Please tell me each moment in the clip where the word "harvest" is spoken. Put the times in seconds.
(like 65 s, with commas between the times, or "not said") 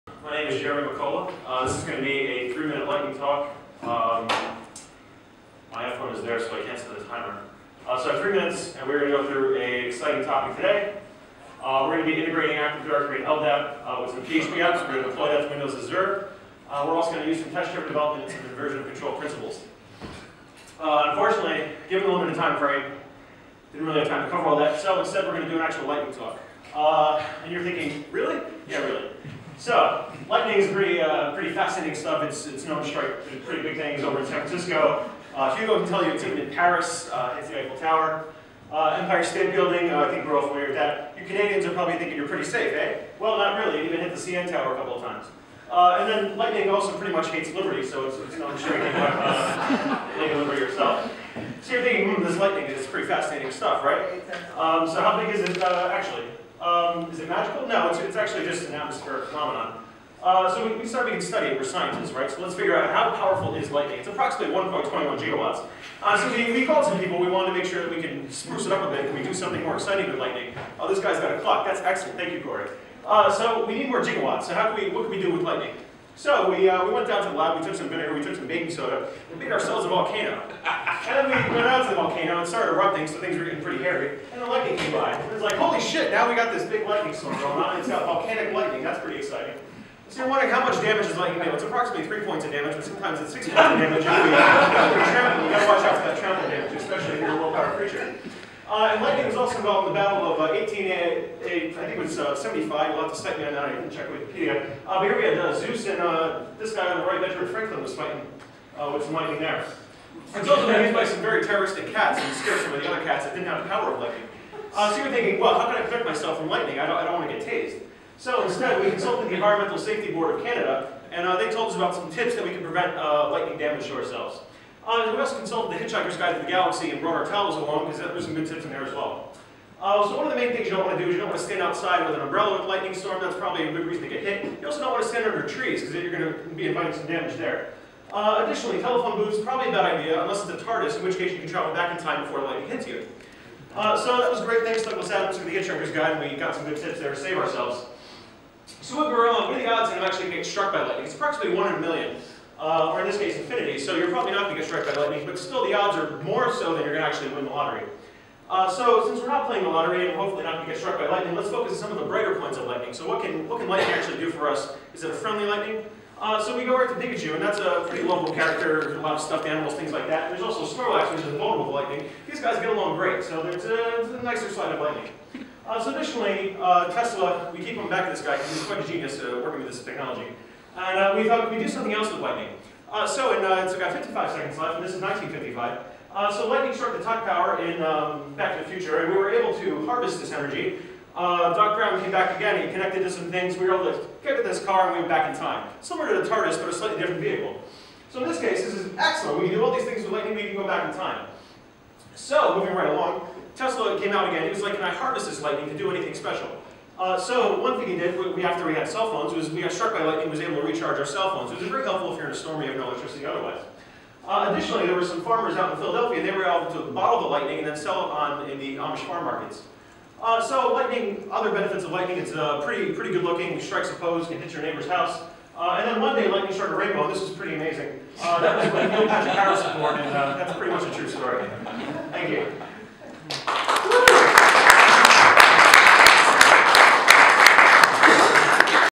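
189 s, 204 s.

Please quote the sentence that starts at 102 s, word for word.
You'll have to uh, check me on that.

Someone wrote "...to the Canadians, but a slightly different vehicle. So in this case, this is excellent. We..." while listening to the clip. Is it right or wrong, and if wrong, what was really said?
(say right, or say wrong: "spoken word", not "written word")
wrong: "TARDIS", not "Canadians".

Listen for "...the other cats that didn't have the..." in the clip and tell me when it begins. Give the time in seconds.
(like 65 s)
112 s.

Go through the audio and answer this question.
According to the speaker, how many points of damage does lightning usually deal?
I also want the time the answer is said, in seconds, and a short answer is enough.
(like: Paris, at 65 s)
3, at 92 s.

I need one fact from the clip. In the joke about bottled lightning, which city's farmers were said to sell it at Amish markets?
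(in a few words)
Philadelphia.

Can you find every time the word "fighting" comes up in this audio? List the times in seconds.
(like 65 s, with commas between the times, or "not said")
107 s.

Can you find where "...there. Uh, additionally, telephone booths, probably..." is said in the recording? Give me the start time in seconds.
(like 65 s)
137 s.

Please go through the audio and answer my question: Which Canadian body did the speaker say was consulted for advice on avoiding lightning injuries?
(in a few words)
Environmental Safety Board of Canada.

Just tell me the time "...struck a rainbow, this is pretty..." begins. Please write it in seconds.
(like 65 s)
226 s.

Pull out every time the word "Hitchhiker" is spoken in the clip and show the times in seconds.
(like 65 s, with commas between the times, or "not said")
125 s, 145 s.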